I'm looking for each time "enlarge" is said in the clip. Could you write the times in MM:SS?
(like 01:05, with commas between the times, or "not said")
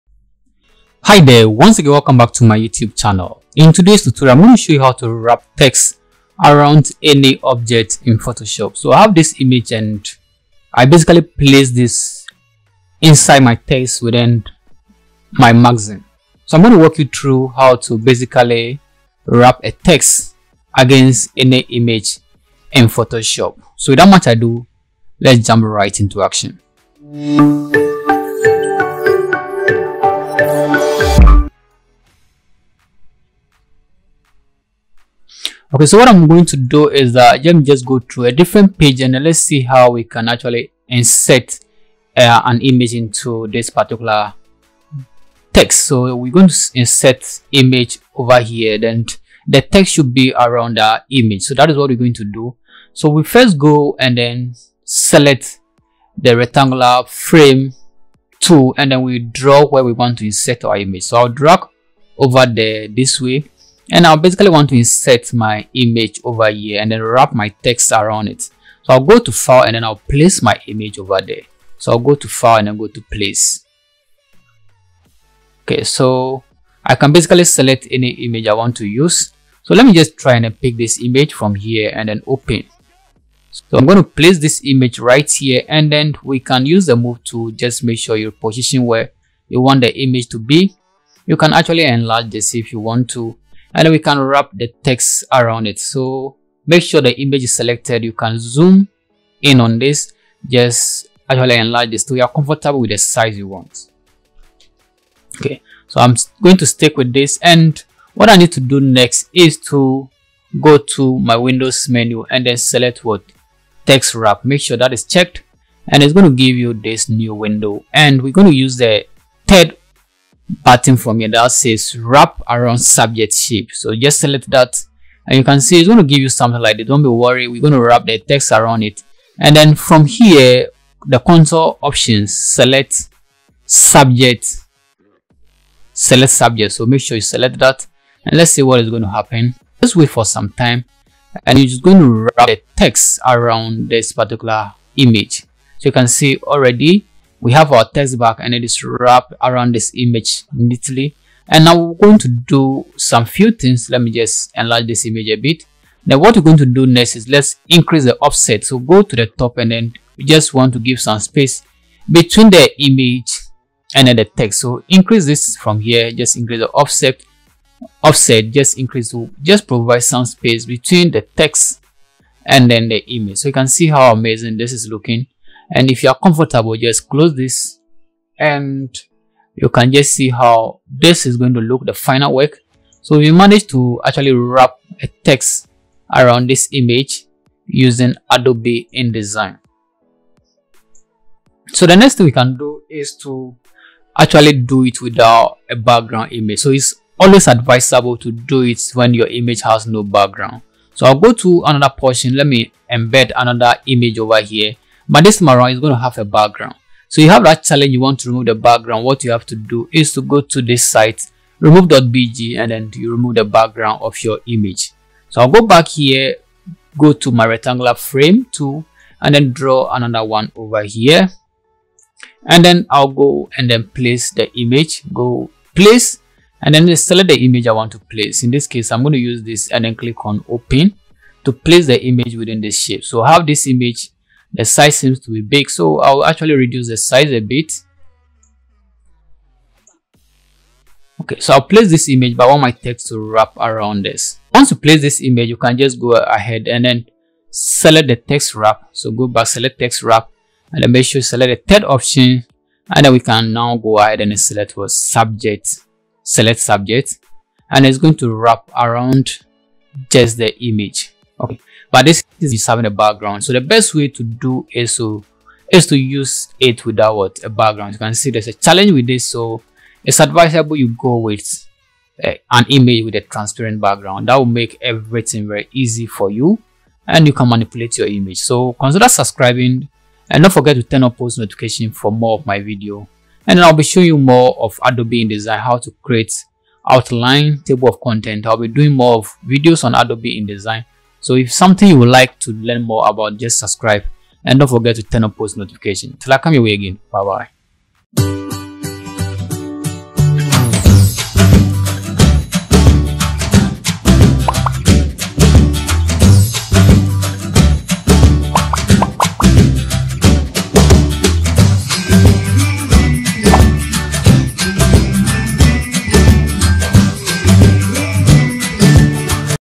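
01:31, 01:41, 02:34.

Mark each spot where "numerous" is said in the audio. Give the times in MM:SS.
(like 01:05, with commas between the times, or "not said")
not said.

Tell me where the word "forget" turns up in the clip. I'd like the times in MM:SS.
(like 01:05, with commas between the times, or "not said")
04:40, 04:54.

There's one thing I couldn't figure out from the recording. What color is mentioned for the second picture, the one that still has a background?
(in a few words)
Maroon.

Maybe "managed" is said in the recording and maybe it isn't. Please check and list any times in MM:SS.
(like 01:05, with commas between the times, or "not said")
03:03.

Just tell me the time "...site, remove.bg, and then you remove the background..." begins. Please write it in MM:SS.
03:30.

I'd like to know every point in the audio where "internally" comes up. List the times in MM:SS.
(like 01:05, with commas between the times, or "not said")
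not said.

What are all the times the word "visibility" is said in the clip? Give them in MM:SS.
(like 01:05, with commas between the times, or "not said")
not said.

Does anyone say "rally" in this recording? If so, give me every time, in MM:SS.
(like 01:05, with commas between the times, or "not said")
not said.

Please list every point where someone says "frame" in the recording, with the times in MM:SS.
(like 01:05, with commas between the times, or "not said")
00:57, 03:37.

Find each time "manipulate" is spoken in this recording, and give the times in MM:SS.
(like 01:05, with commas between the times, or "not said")
04:37.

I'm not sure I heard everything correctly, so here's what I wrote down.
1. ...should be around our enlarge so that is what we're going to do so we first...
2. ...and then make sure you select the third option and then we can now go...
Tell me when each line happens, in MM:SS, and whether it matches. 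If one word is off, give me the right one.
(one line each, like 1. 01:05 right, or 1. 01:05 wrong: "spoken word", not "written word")
1. 00:49 wrong: "image", not "enlarge"
2. 04:10 right.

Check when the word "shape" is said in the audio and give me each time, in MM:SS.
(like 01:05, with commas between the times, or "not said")
02:03, 03:52.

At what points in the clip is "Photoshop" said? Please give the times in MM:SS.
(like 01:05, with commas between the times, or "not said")
00:08, 00:22.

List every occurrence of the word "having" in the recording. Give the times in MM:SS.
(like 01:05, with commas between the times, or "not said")
04:22.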